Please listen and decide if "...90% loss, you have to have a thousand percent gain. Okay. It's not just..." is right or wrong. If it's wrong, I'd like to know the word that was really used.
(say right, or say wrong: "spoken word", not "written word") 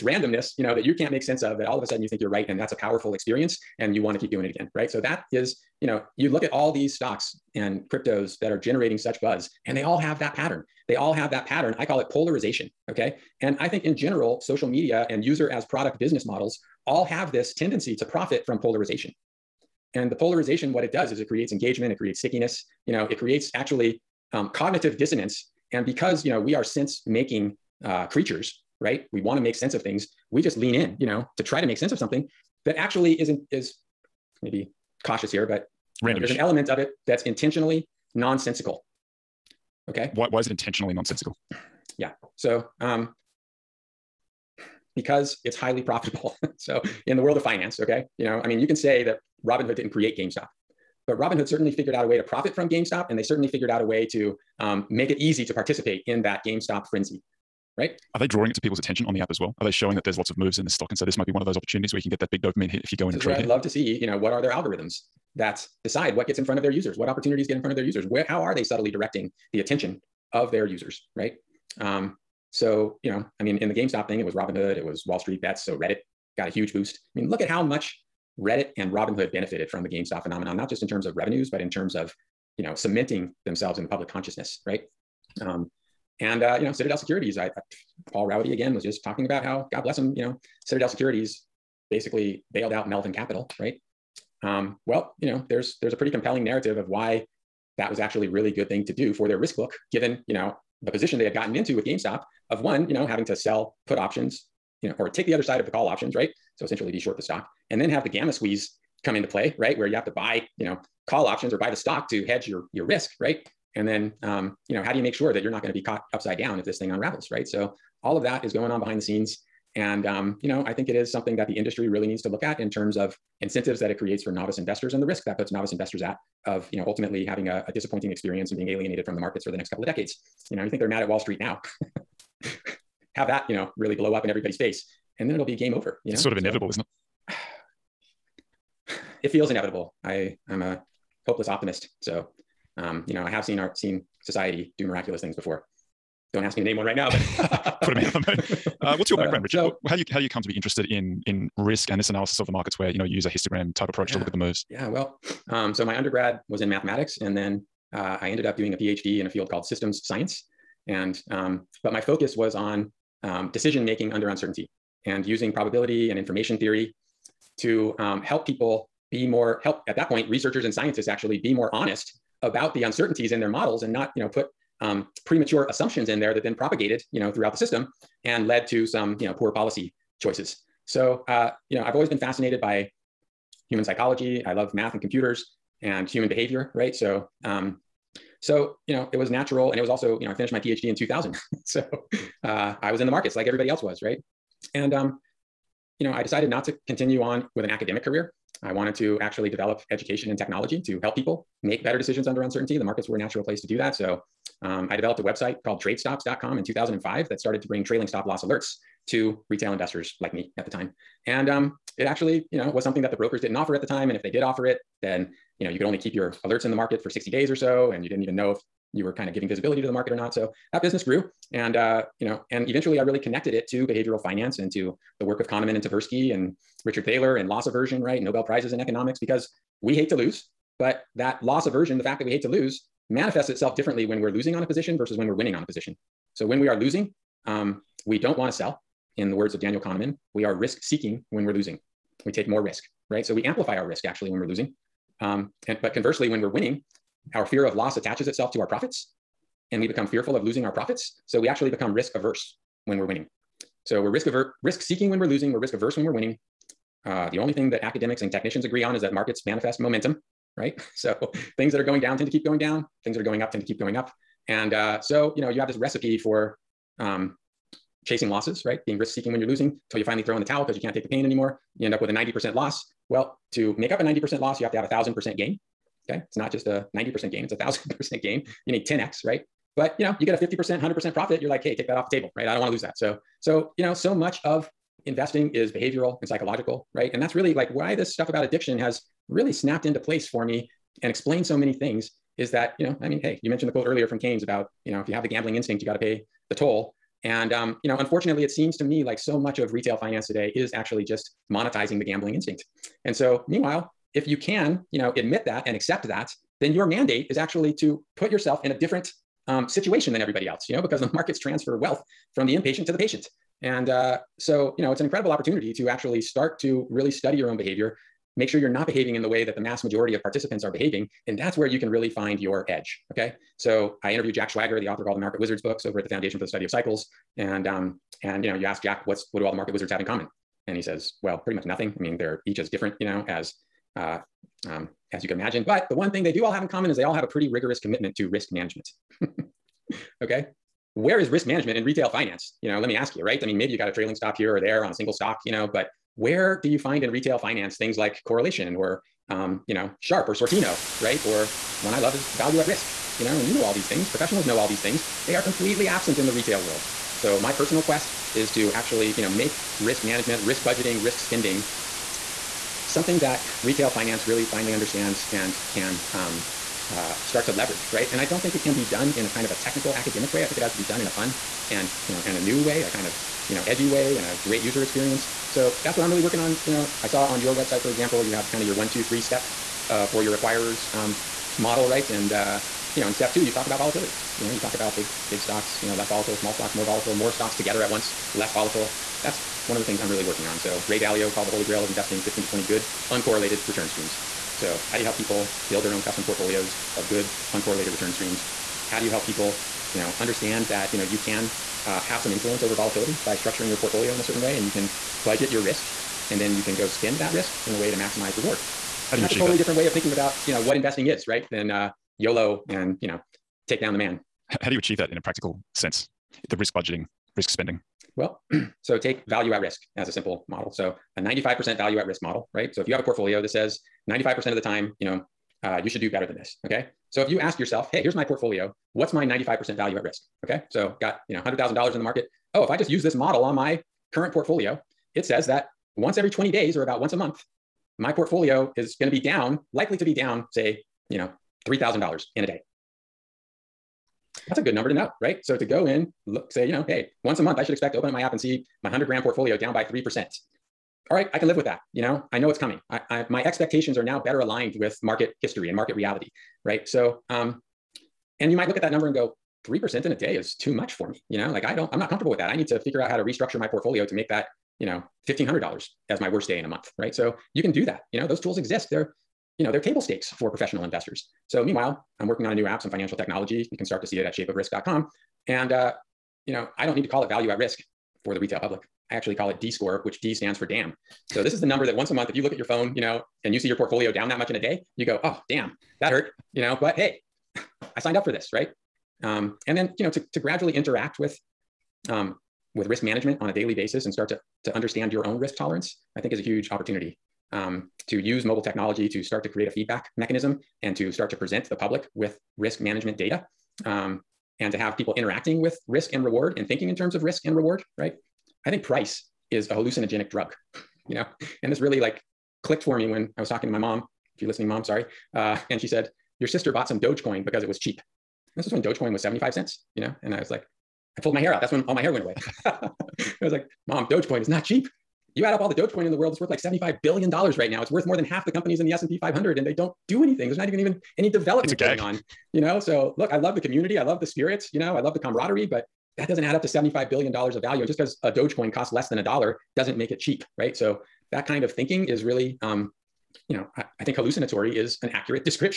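right.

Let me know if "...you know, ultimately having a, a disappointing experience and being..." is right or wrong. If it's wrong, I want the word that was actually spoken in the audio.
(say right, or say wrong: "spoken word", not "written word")
right.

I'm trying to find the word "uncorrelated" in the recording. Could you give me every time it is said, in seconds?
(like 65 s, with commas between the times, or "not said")
393 s, 397 s.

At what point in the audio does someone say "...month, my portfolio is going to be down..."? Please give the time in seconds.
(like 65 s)
437 s.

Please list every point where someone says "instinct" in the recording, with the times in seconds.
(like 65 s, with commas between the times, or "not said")
295 s, 302 s.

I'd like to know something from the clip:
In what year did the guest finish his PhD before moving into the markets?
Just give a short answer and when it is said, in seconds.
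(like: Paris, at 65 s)
2000, at 190 s.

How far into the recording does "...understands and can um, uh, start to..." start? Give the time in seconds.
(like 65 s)
364 s.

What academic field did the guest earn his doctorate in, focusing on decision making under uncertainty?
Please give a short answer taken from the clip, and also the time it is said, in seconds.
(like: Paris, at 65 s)
Systems science, at 159 s.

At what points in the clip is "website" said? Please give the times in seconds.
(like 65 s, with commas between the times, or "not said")
205 s, 377 s.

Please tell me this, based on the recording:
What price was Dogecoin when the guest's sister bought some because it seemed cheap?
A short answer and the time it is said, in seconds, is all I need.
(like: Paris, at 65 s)
75 cents, at 519 s.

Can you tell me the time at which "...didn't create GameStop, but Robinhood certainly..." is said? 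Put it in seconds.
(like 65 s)
49 s.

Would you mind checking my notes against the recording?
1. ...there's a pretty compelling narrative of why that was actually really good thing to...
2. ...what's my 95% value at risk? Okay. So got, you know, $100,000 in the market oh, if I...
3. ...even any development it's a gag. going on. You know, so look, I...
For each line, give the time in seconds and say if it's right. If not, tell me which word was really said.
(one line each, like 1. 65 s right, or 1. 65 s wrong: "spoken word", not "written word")
1. 95 s right
2. 428 s right
3. 530 s right.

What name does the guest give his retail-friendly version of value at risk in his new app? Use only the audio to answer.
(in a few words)
D score.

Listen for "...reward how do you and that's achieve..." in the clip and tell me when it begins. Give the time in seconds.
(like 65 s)
408 s.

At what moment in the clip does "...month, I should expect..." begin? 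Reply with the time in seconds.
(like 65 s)
447 s.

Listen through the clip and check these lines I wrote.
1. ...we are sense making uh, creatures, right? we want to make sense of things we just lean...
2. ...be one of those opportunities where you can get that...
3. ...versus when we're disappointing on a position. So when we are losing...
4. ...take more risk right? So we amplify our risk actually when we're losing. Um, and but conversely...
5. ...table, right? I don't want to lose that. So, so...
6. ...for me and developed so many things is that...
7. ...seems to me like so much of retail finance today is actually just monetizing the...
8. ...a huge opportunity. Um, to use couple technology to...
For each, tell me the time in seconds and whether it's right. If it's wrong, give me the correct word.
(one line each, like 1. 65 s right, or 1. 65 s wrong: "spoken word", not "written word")
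1. 26 s right
2. 61 s right
3. 234 s wrong: "winning", not "disappointing"
4. 242 s right
5. 282 s right
6. 290 s wrong: "explained", not "developed"
7. 298 s right
8. 496 s wrong: "mobile", not "couple".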